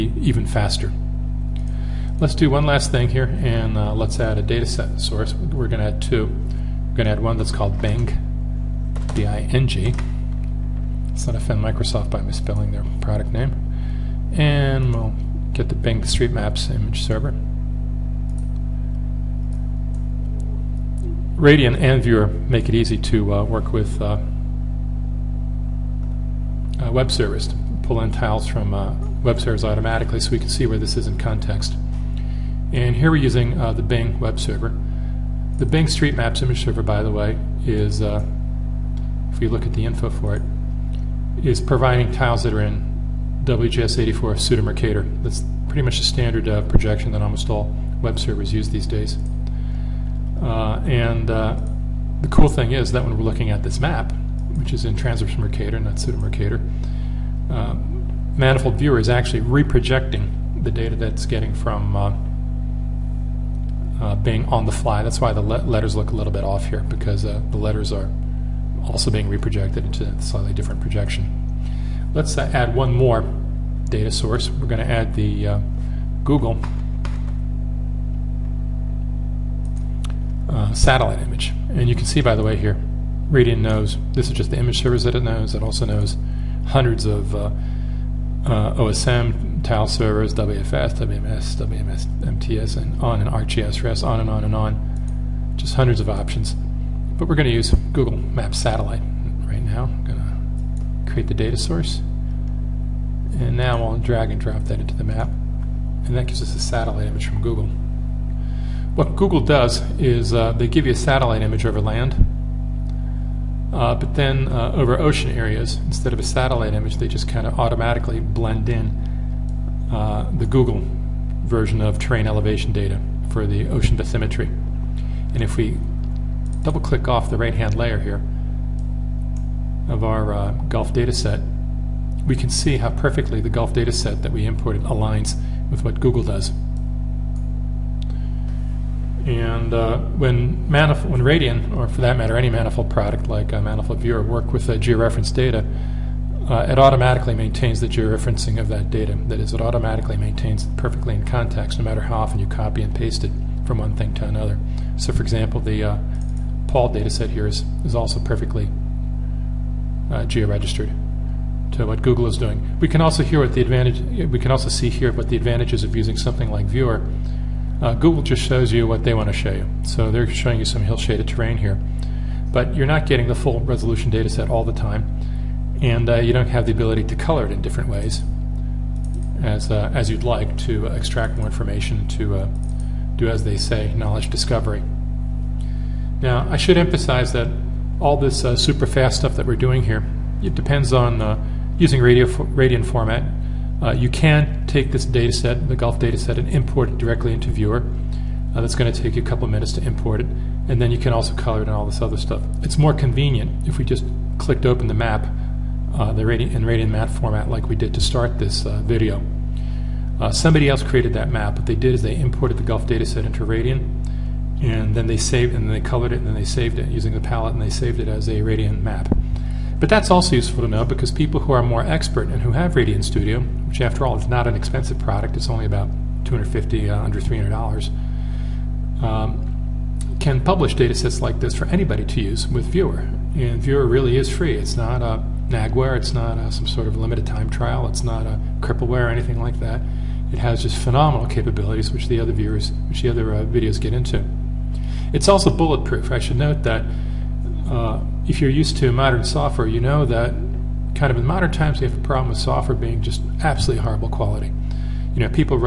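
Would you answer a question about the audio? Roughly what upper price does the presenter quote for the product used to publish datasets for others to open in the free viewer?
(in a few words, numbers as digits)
Under $300.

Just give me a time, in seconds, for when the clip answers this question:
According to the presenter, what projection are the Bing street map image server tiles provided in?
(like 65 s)
43 s.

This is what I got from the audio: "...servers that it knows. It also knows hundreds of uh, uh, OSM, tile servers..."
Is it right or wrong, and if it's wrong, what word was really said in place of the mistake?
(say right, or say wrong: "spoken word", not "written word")
right.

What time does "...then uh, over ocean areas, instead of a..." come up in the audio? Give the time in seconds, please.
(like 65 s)
114 s.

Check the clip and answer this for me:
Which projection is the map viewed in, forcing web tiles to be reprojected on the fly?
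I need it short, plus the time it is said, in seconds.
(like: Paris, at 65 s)
Transverse Mercator, at 54 s.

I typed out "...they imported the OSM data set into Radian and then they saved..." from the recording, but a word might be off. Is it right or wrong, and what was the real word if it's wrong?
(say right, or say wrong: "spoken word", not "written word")
wrong: "Gulf", not "OSM".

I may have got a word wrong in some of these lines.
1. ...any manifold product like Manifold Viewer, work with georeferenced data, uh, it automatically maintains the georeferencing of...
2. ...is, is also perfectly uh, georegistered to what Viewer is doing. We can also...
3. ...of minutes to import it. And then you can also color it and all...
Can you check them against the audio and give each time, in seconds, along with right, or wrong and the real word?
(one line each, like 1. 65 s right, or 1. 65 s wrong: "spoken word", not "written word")
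1. 142 s right
2. 157 s wrong: "Google", not "Viewer"
3. 199 s right.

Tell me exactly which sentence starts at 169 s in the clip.
So they're showing you some hill shaded terrain here.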